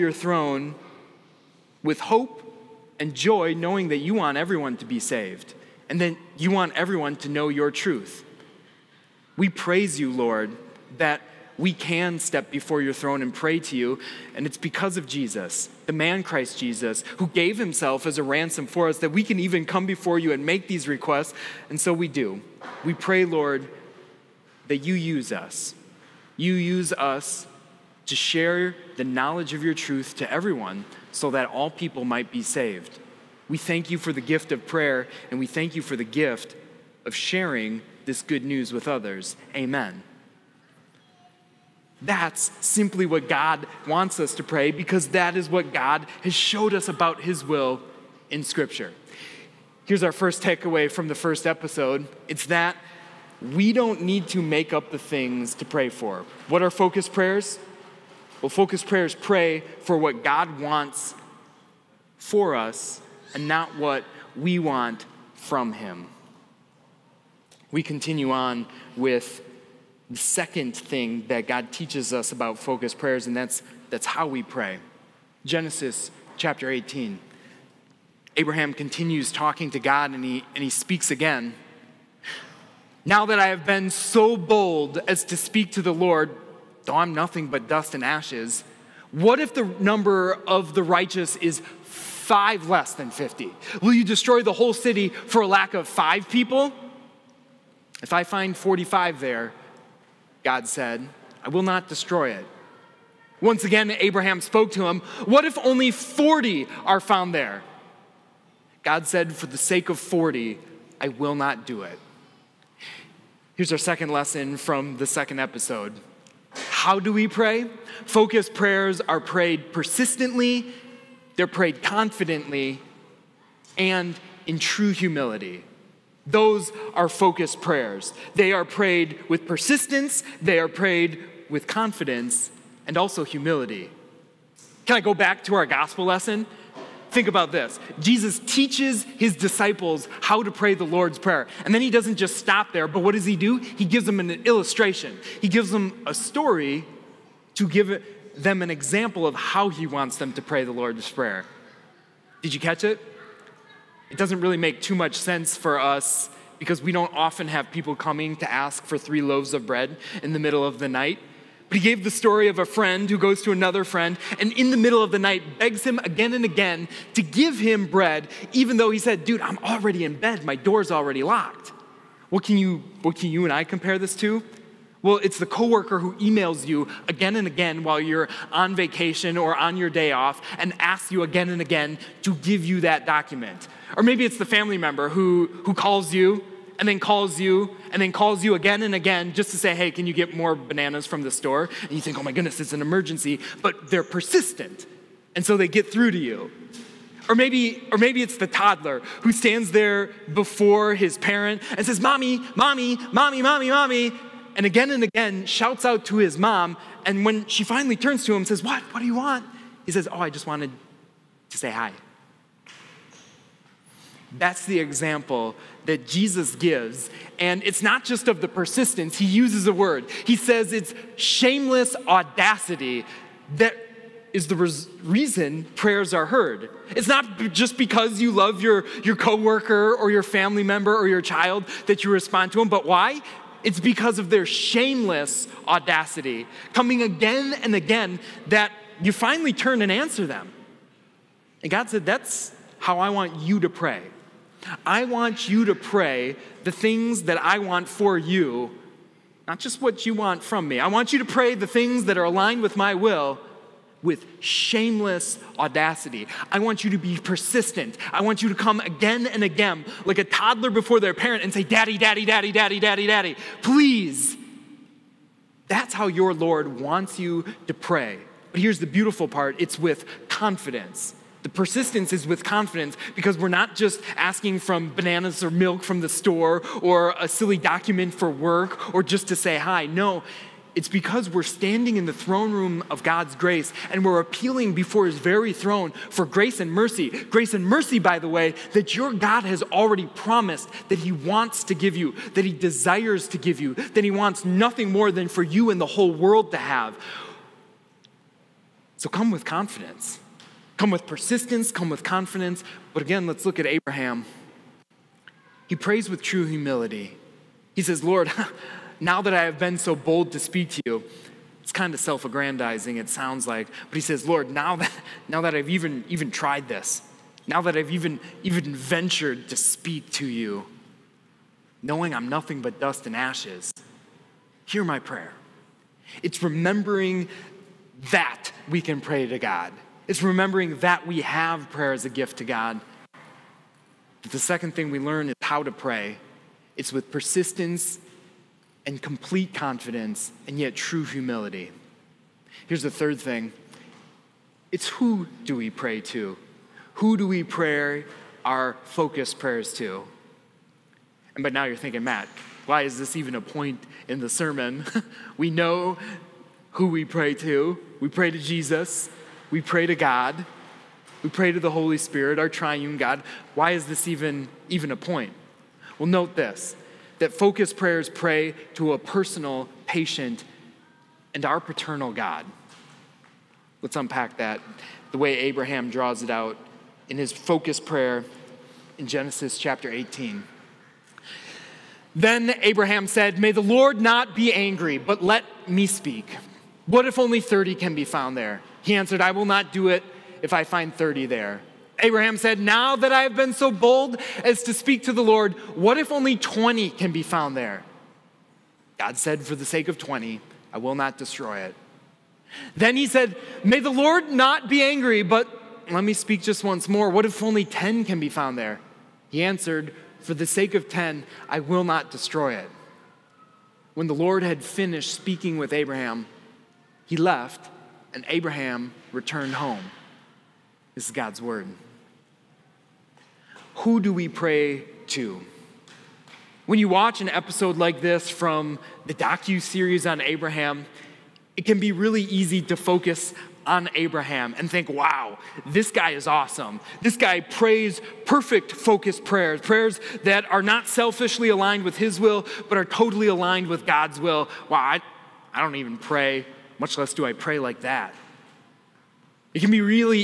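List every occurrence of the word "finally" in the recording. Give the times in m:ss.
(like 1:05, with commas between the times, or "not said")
3:27, 3:59.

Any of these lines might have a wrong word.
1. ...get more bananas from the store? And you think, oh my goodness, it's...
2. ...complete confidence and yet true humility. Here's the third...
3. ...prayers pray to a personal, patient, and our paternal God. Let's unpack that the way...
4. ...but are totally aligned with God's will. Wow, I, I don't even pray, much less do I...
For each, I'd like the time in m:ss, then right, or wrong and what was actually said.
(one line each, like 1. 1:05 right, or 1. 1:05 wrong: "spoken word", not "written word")
1. 3:10 right
2. 5:39 right
3. 6:07 right
4. 7:22 right.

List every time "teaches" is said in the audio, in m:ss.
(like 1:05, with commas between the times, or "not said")
1:11, 2:18.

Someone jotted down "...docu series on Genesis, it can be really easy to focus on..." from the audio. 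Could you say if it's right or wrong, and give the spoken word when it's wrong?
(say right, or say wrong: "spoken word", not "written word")
wrong: "Abraham", not "Genesis".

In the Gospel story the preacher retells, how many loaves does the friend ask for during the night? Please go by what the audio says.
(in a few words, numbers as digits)
3.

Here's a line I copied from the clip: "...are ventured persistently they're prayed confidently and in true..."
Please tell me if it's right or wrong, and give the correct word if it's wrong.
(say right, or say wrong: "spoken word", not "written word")
wrong: "prayed", not "ventured".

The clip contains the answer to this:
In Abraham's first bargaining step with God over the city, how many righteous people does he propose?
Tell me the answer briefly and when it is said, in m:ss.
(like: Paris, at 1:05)
45, at 1:38.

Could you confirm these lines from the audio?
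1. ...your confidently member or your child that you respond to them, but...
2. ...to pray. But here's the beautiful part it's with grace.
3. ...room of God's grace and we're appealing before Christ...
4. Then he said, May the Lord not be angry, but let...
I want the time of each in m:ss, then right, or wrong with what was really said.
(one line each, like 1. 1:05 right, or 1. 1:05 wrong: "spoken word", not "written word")
1. 3:50 wrong: "family", not "confidently"
2. 4:27 wrong: "confidence", not "grace"
3. 4:42 wrong: "His", not "Christ"
4. 6:42 right.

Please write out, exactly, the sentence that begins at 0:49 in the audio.
Here's our first takeaway from the first episode it's that we don't need to make up the things to pray for.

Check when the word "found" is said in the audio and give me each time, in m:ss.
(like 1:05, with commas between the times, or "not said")
1:46, 6:28, 6:37, 6:48.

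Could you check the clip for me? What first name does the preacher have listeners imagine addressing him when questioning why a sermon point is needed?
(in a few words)
Matt.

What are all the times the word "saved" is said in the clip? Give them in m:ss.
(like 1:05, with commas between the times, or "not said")
0:04, 0:32.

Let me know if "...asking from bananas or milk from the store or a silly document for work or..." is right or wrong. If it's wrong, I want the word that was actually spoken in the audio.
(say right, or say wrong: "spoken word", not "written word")
right.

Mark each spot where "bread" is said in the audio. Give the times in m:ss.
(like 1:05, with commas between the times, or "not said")
2:39, 2:47.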